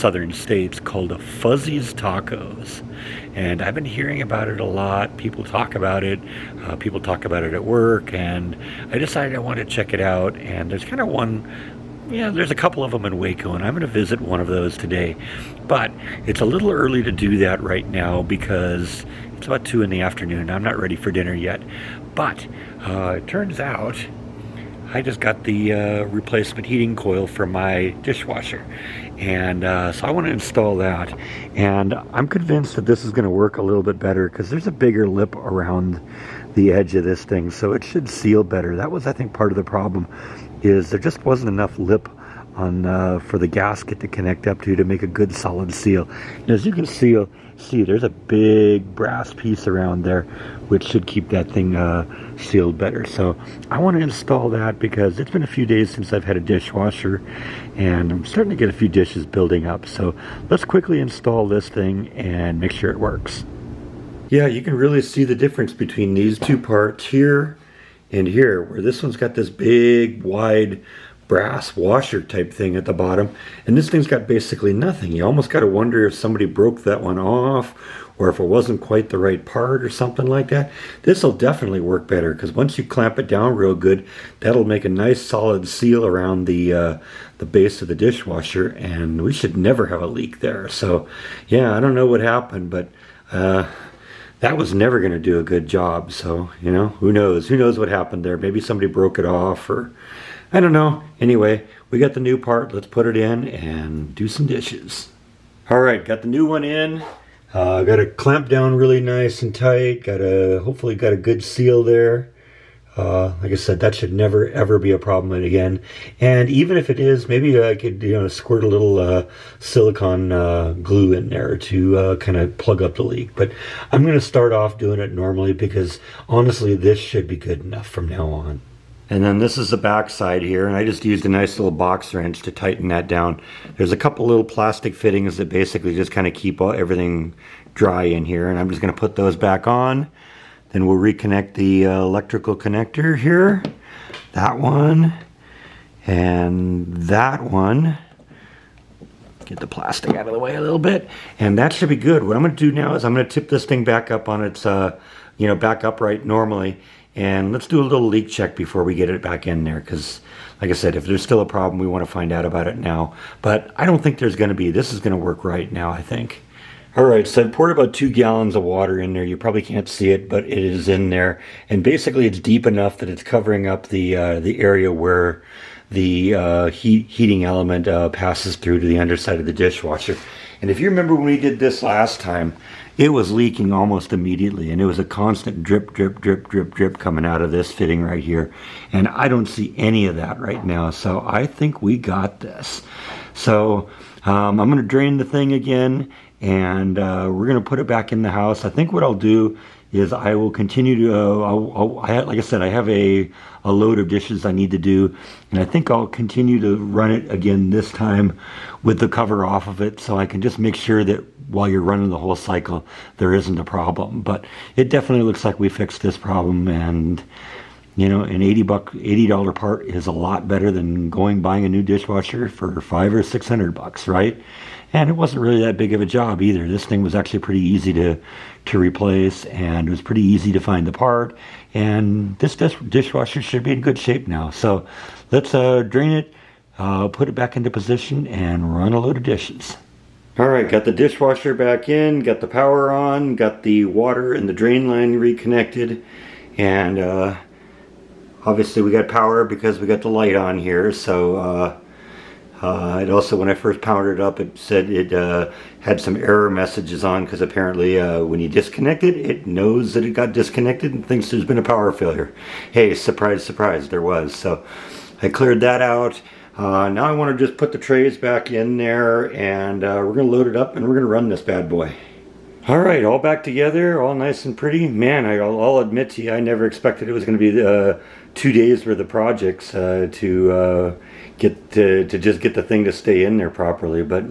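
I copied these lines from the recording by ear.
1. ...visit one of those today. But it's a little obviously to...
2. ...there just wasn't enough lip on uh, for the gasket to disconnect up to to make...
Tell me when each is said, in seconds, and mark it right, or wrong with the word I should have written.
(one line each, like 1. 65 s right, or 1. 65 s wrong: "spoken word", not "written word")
1. 13 s wrong: "early", not "obviously"
2. 40 s wrong: "connect", not "disconnect".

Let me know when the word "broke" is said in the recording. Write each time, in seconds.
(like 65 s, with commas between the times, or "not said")
76 s, 98 s.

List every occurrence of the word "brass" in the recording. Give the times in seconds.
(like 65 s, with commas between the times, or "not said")
48 s, 71 s.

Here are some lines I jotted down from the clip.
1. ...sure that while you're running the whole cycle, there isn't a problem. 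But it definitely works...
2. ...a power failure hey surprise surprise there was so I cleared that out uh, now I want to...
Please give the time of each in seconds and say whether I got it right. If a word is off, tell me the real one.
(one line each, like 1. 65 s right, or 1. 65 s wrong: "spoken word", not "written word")
1. 210 s wrong: "looks", not "works"
2. 261 s right.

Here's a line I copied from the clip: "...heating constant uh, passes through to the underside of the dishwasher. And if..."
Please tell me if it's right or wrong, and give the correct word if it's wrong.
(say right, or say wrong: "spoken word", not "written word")
wrong: "element", not "constant".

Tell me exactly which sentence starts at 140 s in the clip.
Then we'll reconnect the uh, electrical connector here.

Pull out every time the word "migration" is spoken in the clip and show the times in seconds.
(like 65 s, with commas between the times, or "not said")
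not said.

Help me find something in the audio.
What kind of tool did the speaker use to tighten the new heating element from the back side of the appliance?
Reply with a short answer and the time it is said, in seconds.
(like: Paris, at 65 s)
box wrench, at 131 s.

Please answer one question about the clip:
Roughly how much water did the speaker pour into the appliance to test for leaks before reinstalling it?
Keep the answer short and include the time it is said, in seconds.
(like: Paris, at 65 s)
2 gallons, at 167 s.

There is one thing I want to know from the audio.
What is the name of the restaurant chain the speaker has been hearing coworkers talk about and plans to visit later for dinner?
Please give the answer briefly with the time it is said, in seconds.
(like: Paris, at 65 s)
Fuzzy's Tacos, at 1 s.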